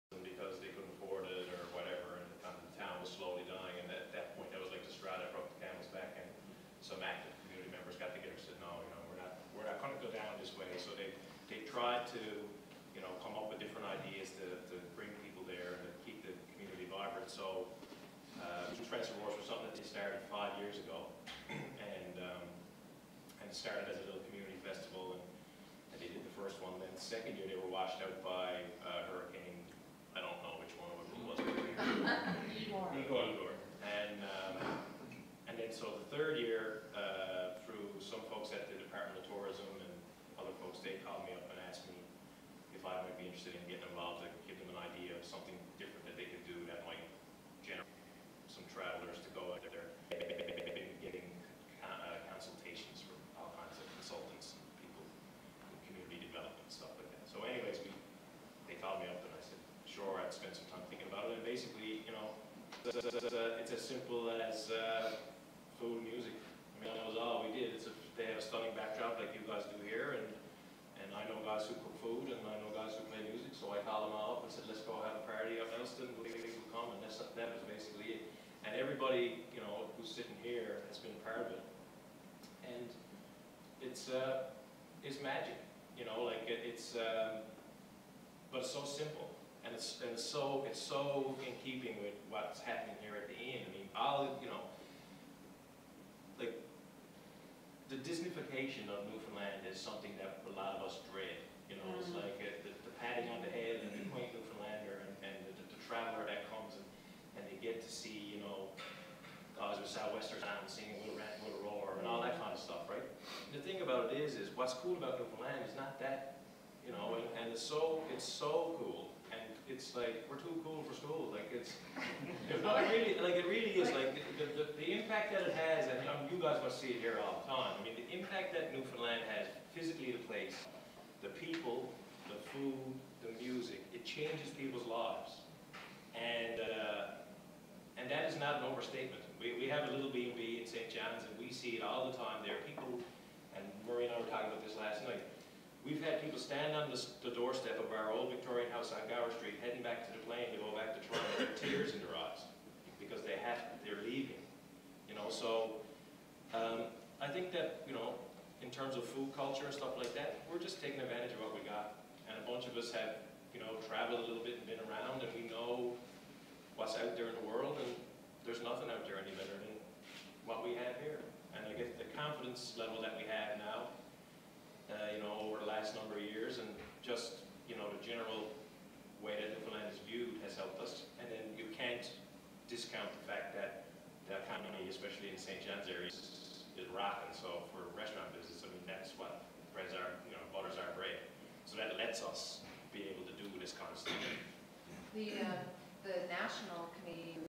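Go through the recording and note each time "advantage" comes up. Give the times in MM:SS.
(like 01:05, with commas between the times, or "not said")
02:41.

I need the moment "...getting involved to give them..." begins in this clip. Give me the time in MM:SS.
00:43.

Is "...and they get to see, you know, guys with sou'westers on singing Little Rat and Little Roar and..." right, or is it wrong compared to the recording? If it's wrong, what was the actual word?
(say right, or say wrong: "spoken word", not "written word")
right.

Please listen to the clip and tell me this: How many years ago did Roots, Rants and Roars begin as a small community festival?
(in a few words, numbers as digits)
5.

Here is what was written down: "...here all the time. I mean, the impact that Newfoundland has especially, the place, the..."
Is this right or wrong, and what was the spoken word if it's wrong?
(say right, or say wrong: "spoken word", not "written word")
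wrong: "physically", not "especially".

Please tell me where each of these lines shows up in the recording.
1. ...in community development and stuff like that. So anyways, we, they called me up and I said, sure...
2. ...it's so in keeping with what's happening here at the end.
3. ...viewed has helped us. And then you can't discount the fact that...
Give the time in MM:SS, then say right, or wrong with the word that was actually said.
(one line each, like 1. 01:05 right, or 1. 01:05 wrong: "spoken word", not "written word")
1. 00:55 right
2. 01:30 right
3. 03:00 right.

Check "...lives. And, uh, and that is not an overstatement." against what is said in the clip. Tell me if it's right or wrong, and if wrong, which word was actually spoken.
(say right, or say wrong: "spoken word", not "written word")
right.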